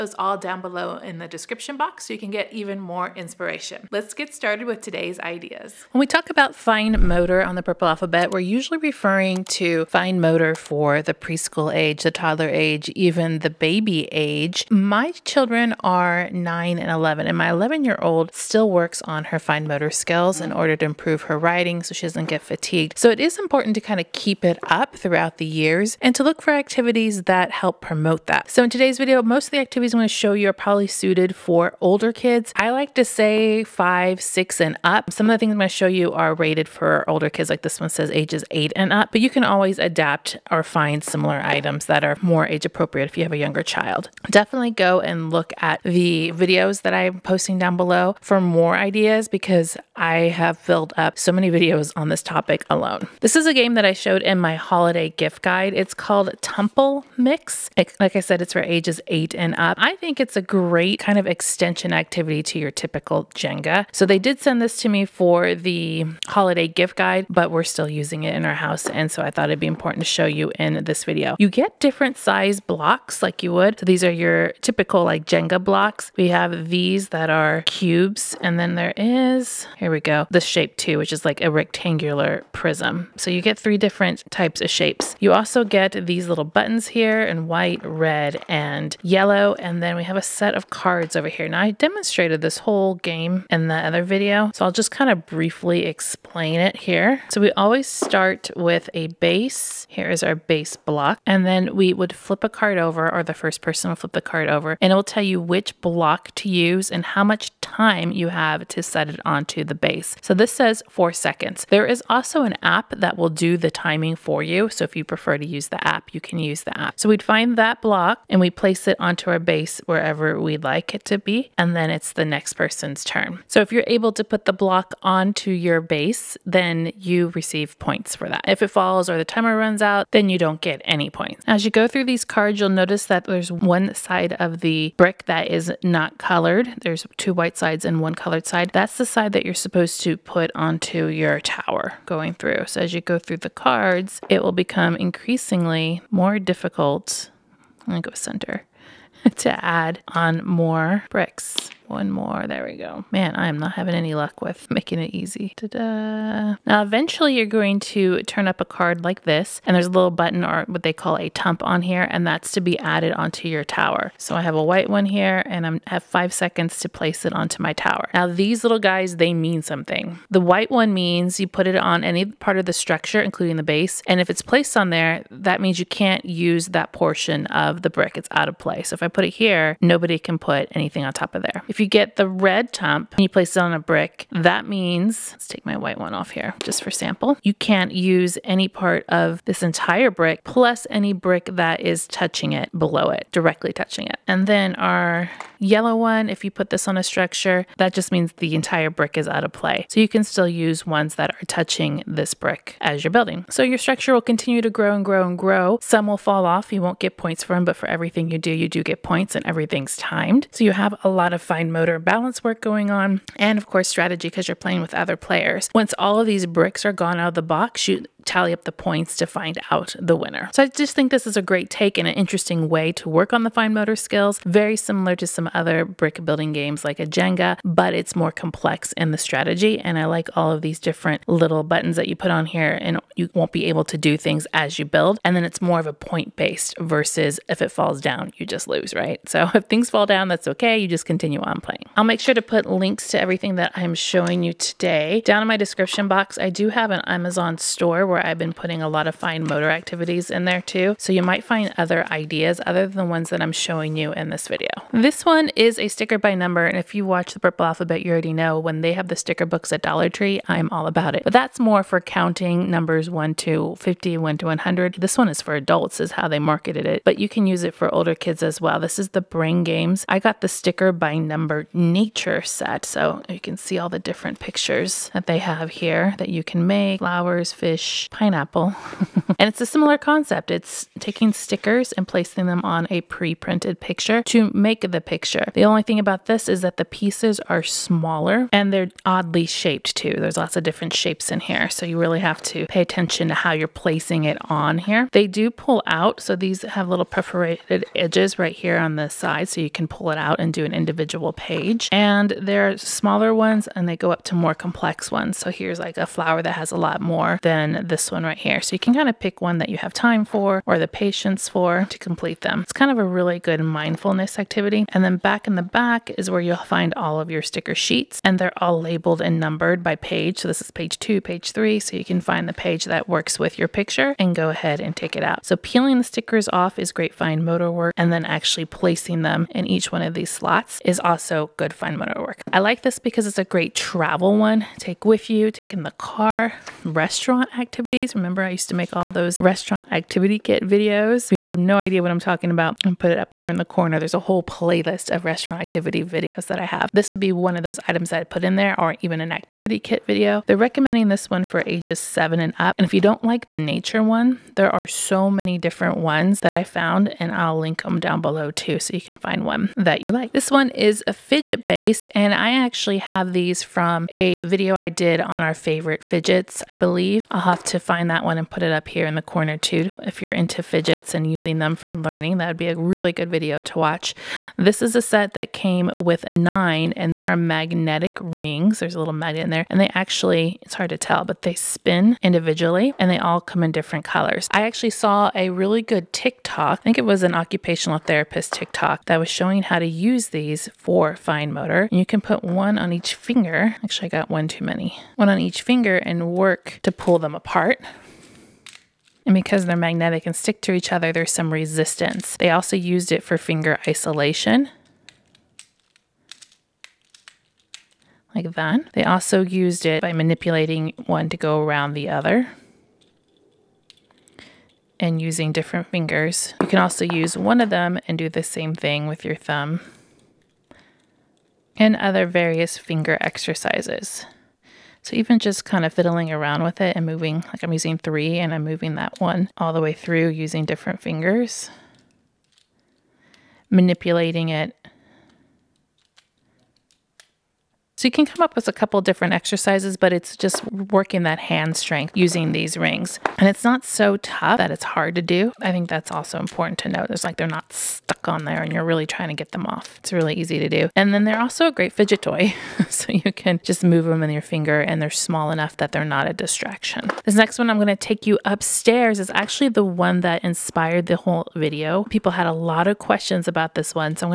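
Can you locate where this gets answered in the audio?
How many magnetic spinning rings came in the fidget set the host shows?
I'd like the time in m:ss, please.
6:16.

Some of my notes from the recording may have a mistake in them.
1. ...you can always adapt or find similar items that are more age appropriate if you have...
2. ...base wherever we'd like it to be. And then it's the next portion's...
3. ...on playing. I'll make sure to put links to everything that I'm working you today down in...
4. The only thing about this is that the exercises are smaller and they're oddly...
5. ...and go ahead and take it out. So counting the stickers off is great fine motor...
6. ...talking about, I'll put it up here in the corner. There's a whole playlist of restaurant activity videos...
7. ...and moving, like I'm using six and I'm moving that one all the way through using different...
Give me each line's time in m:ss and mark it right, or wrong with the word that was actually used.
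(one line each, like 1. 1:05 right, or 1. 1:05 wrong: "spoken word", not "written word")
1. 0:39 right
2. 1:59 wrong: "person", not "portion"
3. 4:01 wrong: "showing", not "working"
4. 4:45 wrong: "pieces", not "exercises"
5. 5:24 wrong: "peeling", not "counting"
6. 5:42 right
7. 7:06 wrong: "three", not "six".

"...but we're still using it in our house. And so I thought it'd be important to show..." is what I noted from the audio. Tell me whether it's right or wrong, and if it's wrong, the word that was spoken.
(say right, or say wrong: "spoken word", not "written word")
right.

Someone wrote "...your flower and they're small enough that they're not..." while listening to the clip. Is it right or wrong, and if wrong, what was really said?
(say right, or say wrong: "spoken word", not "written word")
wrong: "finger", not "flower".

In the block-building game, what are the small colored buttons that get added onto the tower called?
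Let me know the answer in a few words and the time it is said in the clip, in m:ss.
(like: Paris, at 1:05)
tump, at 2:41.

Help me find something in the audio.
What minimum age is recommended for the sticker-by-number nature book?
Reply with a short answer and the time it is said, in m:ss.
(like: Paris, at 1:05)
7, at 5:51.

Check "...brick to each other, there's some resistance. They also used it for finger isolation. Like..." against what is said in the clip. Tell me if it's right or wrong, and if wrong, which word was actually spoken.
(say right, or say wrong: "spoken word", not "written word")
wrong: "stick", not "brick".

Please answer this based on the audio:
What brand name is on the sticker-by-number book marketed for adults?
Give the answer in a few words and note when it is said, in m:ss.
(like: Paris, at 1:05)
Brain Games, at 4:29.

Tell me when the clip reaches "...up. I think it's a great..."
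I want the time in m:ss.
0:59.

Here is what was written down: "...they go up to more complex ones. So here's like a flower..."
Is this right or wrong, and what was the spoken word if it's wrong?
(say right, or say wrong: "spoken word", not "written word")
right.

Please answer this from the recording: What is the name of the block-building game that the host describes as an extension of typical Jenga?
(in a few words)
Tummple Mix.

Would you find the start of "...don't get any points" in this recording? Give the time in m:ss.
2:10.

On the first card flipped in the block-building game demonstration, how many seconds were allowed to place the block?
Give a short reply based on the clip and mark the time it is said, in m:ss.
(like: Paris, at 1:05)
4, at 1:50.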